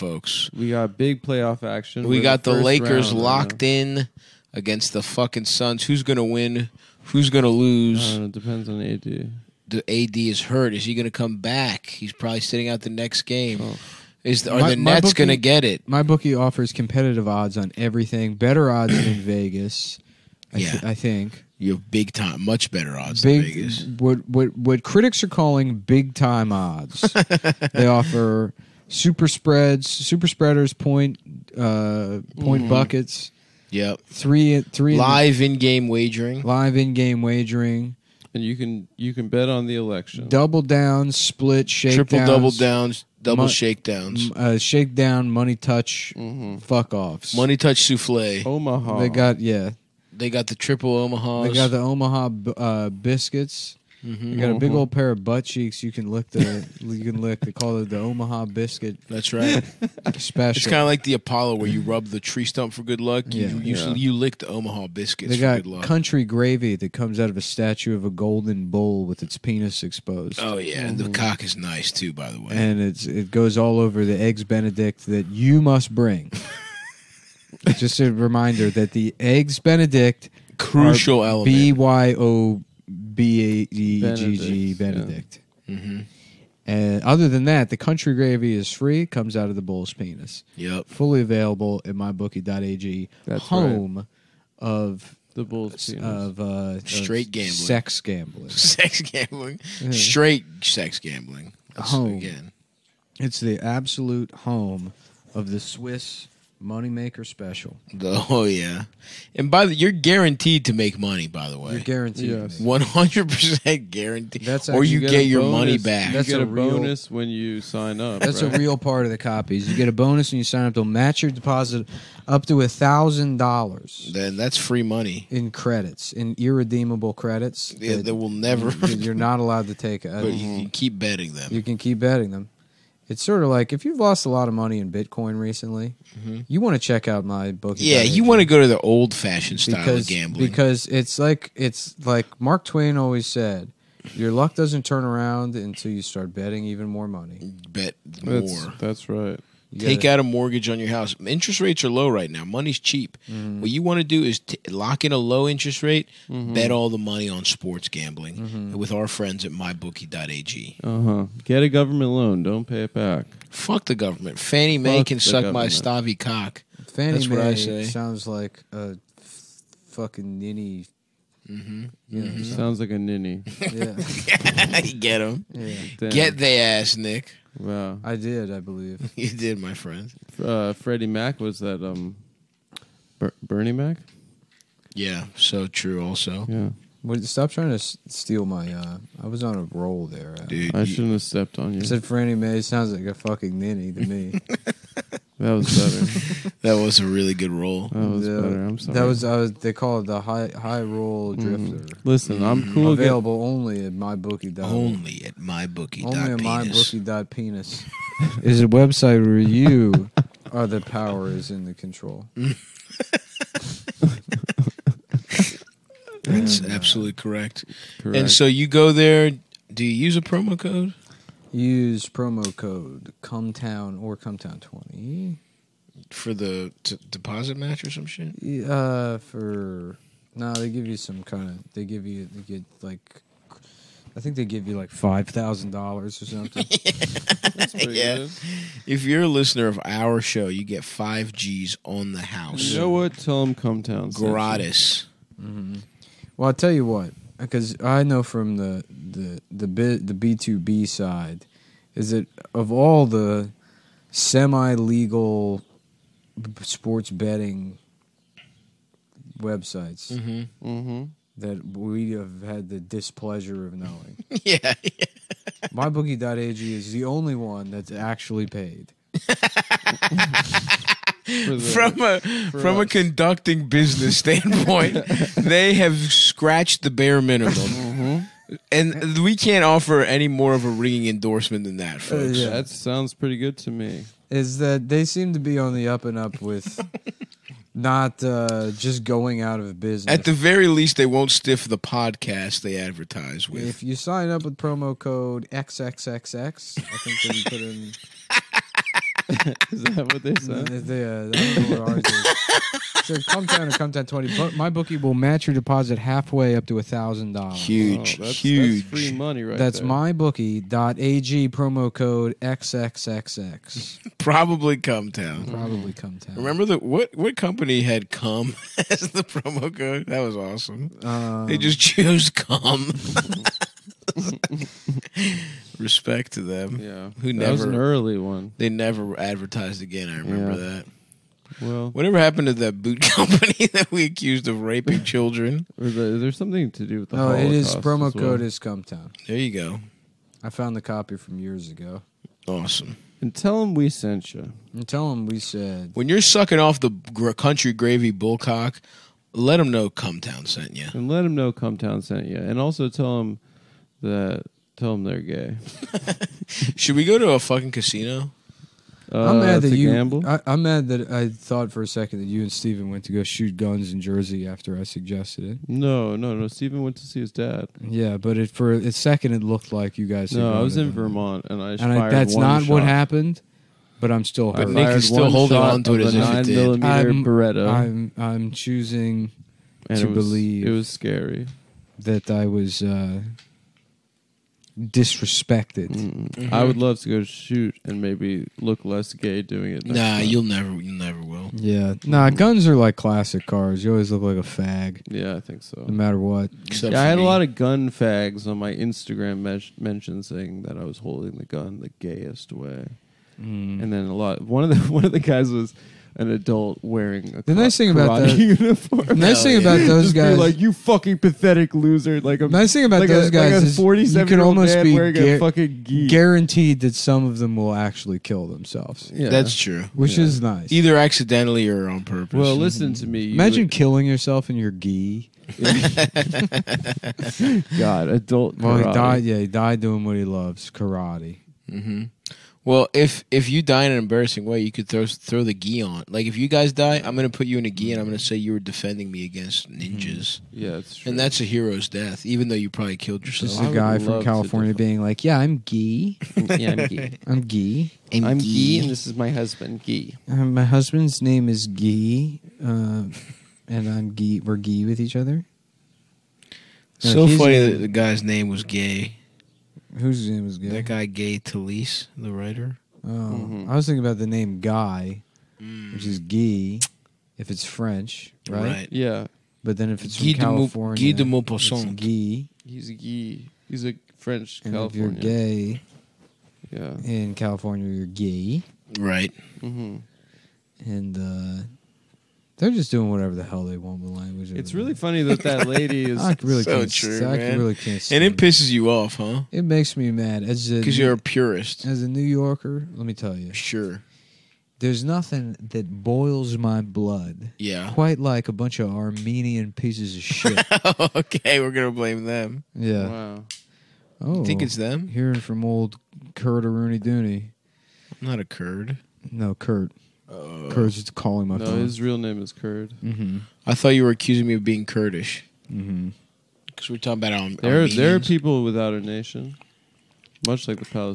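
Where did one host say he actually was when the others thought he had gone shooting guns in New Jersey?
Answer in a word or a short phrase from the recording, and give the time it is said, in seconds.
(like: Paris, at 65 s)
Vermont, at 370 s.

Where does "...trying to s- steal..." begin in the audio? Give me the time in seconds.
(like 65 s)
187 s.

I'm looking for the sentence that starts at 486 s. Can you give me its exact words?
I really so can't, true, I man.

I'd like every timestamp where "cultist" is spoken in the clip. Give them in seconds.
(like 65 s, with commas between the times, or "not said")
not said.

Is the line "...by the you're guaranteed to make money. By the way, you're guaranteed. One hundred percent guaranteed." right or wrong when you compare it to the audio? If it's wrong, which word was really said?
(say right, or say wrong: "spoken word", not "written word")
right.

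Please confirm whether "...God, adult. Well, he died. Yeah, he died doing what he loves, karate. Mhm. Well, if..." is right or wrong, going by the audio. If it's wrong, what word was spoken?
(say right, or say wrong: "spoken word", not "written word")
right.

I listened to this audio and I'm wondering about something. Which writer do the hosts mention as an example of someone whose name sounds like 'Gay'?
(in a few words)
Gay Talese.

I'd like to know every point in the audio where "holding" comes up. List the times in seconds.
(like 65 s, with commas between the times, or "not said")
375 s, 400 s.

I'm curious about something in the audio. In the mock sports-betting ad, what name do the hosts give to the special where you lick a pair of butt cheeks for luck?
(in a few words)
Omaha biscuit.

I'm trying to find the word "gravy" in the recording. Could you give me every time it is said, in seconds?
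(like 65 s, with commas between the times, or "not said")
66 s, 88 s, 347 s.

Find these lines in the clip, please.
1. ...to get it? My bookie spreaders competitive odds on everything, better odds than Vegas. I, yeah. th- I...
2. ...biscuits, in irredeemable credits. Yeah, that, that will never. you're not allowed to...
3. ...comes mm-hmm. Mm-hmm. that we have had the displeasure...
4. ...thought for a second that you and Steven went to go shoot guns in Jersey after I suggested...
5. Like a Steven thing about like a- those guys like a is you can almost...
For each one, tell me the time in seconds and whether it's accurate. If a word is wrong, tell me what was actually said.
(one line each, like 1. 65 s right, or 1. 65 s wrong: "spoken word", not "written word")
1. 15 s wrong: "offers", not "spreaders"
2. 125 s wrong: "credits", not "biscuits"
3. 259 s wrong: "websites", not "comes"
4. 361 s right
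5. 412 s wrong: "Nice", not "Steven".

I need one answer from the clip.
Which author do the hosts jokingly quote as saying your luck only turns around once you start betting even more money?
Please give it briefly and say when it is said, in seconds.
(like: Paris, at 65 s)
Mark Twain, at 142 s.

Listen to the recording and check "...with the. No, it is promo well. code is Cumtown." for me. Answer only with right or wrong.
right.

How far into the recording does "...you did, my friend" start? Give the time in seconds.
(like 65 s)
179 s.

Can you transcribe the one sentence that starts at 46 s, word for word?
fuck offs, money touch souffle, Omaha.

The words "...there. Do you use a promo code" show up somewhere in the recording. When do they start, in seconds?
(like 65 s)
218 s.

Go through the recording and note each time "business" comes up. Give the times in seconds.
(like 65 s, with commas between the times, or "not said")
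273 s, 289 s.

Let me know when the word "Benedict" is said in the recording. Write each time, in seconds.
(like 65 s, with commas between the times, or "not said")
74 s, 79 s, 84 s.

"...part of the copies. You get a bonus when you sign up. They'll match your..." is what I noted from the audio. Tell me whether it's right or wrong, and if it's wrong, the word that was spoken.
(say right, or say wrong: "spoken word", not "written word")
right.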